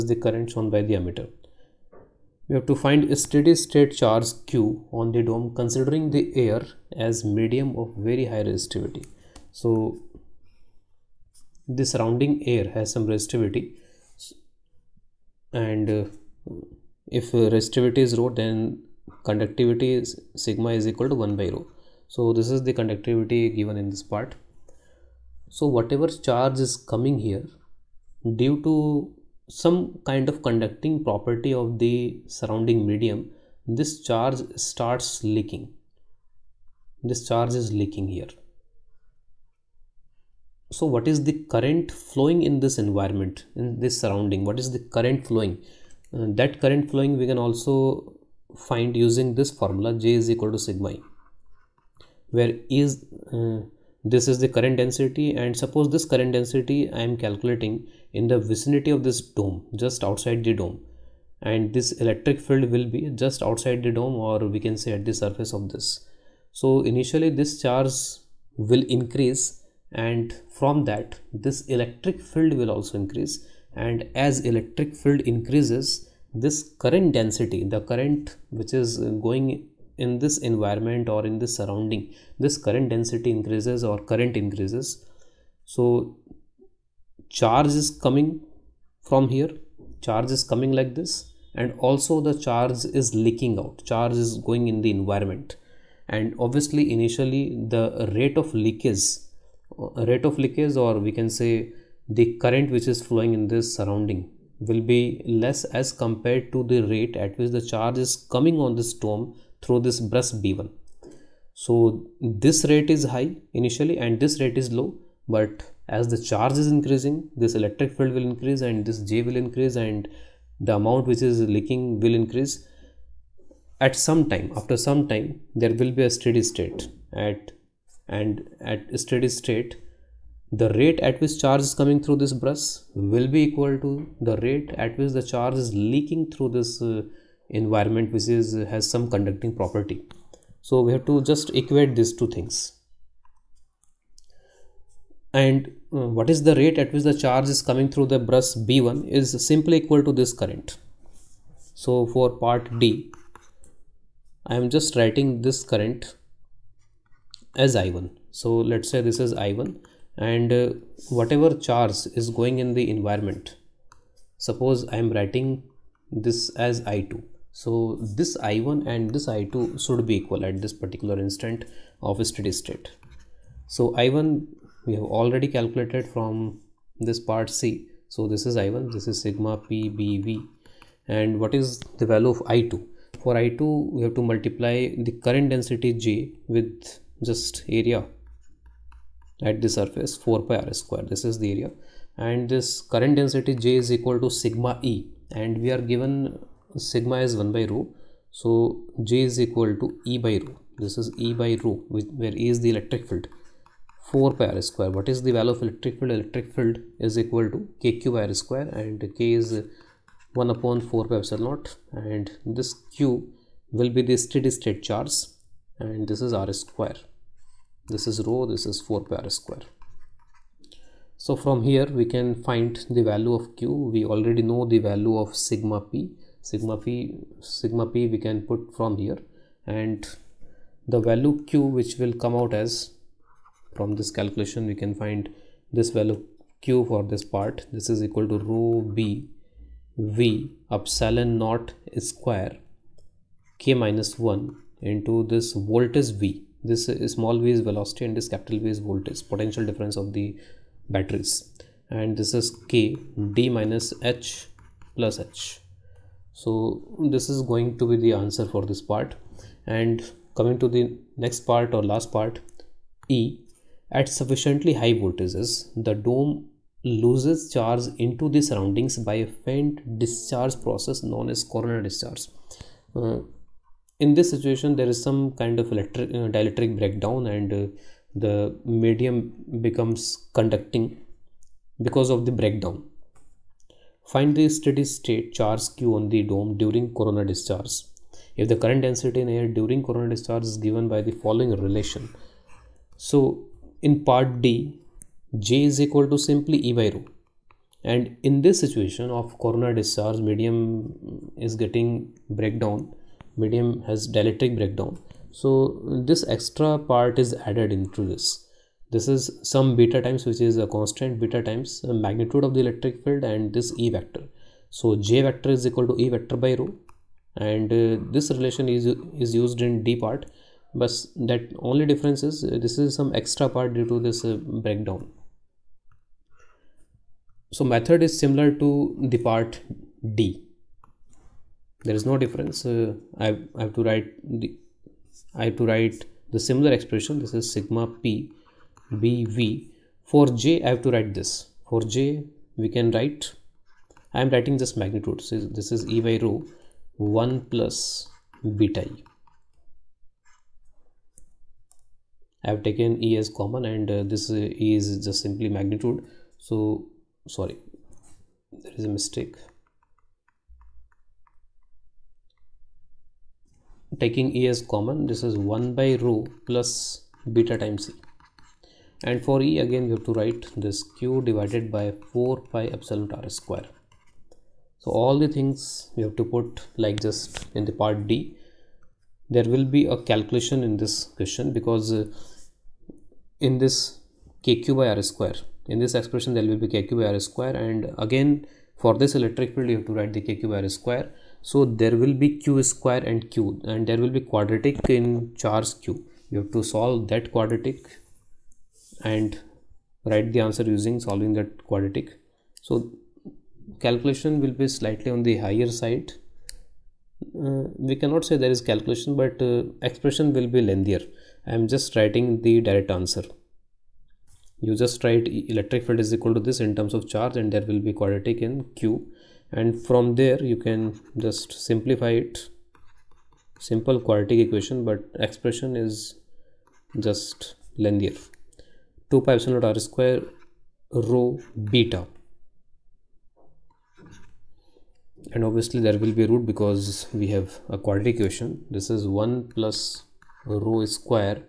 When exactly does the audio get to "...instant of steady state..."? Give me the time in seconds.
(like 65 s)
171 s.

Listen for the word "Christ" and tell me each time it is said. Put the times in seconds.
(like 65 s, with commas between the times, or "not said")
not said.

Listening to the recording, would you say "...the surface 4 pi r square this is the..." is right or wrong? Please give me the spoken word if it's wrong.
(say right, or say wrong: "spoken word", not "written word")
right.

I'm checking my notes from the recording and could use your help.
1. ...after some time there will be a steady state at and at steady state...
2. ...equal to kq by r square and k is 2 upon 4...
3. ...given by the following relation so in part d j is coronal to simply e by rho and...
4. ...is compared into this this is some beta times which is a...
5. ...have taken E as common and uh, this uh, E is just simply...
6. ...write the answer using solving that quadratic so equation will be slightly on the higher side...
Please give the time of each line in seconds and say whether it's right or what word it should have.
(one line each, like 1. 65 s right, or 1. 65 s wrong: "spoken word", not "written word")
1. 124 s right
2. 207 s wrong: "1", not "2"
3. 290 s wrong: "equal", not "coronal"
4. 307 s wrong: "added", not "compared"
5. 352 s right
6. 400 s wrong: "calculation", not "equation".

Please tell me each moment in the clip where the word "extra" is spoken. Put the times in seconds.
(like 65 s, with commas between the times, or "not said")
306 s, 323 s.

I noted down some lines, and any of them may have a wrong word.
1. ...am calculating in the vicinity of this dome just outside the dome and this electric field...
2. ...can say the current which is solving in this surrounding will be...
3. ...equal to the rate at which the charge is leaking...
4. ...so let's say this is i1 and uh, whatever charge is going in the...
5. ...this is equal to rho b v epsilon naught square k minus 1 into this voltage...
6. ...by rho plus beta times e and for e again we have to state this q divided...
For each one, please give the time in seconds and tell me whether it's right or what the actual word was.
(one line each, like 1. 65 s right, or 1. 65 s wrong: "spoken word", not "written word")
1. 57 s right
2. 101 s wrong: "flowing", not "solving"
3. 133 s right
4. 158 s right
5. 237 s right
6. 365 s wrong: "write", not "state".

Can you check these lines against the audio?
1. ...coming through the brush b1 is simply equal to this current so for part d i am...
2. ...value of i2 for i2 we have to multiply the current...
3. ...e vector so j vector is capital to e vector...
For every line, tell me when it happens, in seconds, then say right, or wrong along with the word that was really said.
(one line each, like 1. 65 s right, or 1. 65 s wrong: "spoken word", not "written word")
1. 147 s right
2. 182 s right
3. 313 s wrong: "equal", not "capital".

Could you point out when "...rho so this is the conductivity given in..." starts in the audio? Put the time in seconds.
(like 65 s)
21 s.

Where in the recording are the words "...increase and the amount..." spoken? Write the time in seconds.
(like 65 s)
119 s.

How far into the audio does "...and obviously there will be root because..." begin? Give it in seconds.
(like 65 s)
435 s.